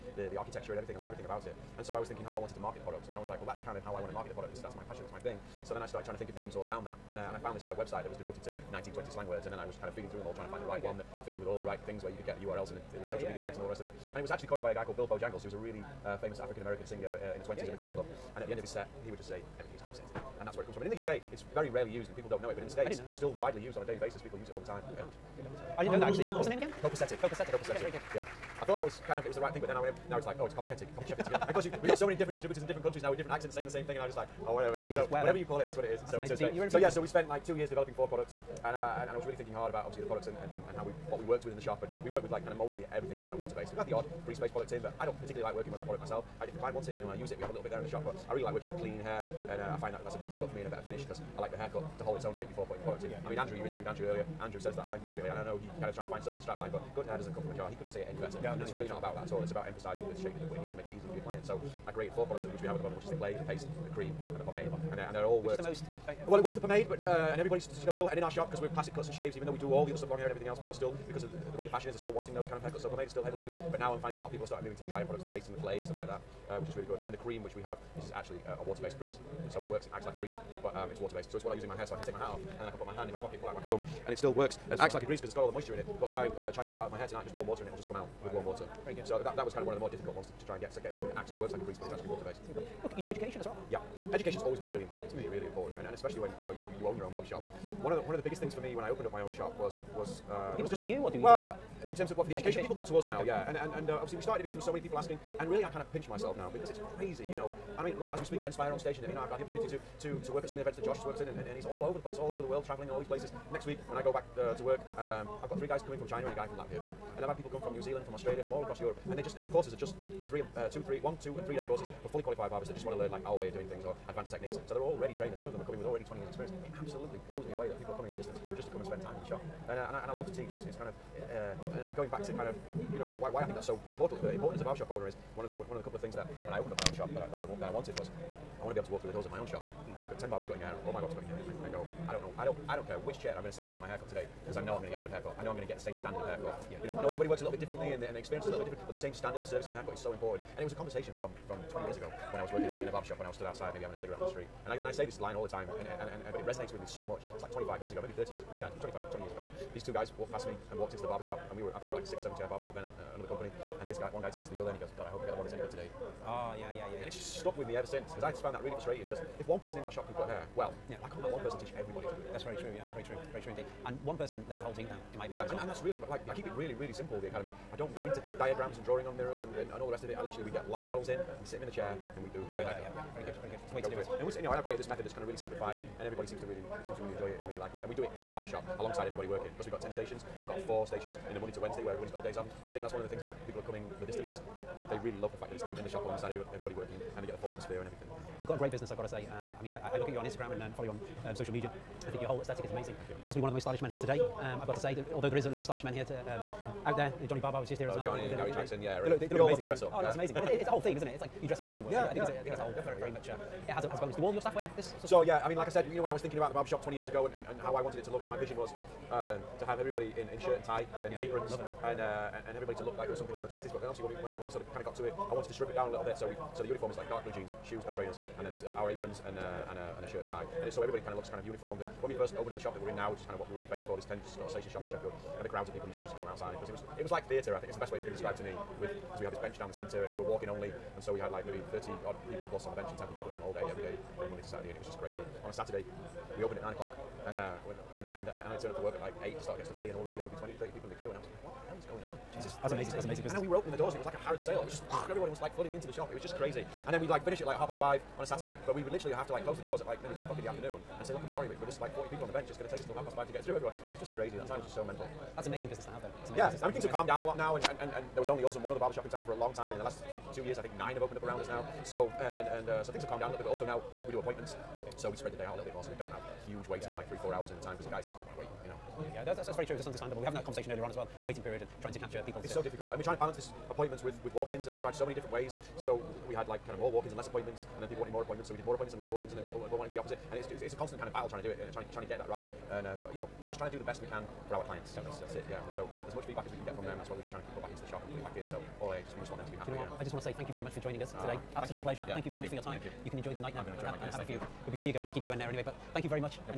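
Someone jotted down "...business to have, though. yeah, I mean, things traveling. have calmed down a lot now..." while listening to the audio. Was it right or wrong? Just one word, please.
wrong.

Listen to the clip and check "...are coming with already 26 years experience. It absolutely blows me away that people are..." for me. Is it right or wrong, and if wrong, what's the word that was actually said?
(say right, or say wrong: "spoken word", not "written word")
wrong: "20", not "26".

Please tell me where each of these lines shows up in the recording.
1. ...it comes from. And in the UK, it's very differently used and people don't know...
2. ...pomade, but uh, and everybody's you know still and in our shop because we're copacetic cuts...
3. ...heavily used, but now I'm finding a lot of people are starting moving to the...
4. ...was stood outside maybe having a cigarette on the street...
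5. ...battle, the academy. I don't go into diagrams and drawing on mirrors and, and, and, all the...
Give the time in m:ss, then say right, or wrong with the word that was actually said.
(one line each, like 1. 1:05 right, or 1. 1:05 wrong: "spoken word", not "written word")
1. 0:20 wrong: "rarely", not "differently"
2. 1:06 wrong: "classic", not "copacetic"
3. 1:13 right
4. 2:33 right
5. 2:56 wrong: "simple", not "battle".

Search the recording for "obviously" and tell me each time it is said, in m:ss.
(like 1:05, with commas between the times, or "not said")
0:39, 1:44, 3:43.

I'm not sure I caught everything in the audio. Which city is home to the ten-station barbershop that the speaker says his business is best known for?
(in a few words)
Sheffield.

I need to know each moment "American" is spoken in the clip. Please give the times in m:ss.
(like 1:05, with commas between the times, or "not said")
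0:16.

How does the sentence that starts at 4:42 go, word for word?
It's so difficult, and we're trying to balance this appointments with with walk-ins, and I've tried so many different ways.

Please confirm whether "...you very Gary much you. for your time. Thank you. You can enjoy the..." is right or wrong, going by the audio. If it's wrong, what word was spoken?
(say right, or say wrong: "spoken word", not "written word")
wrong: "Thank", not "Gary".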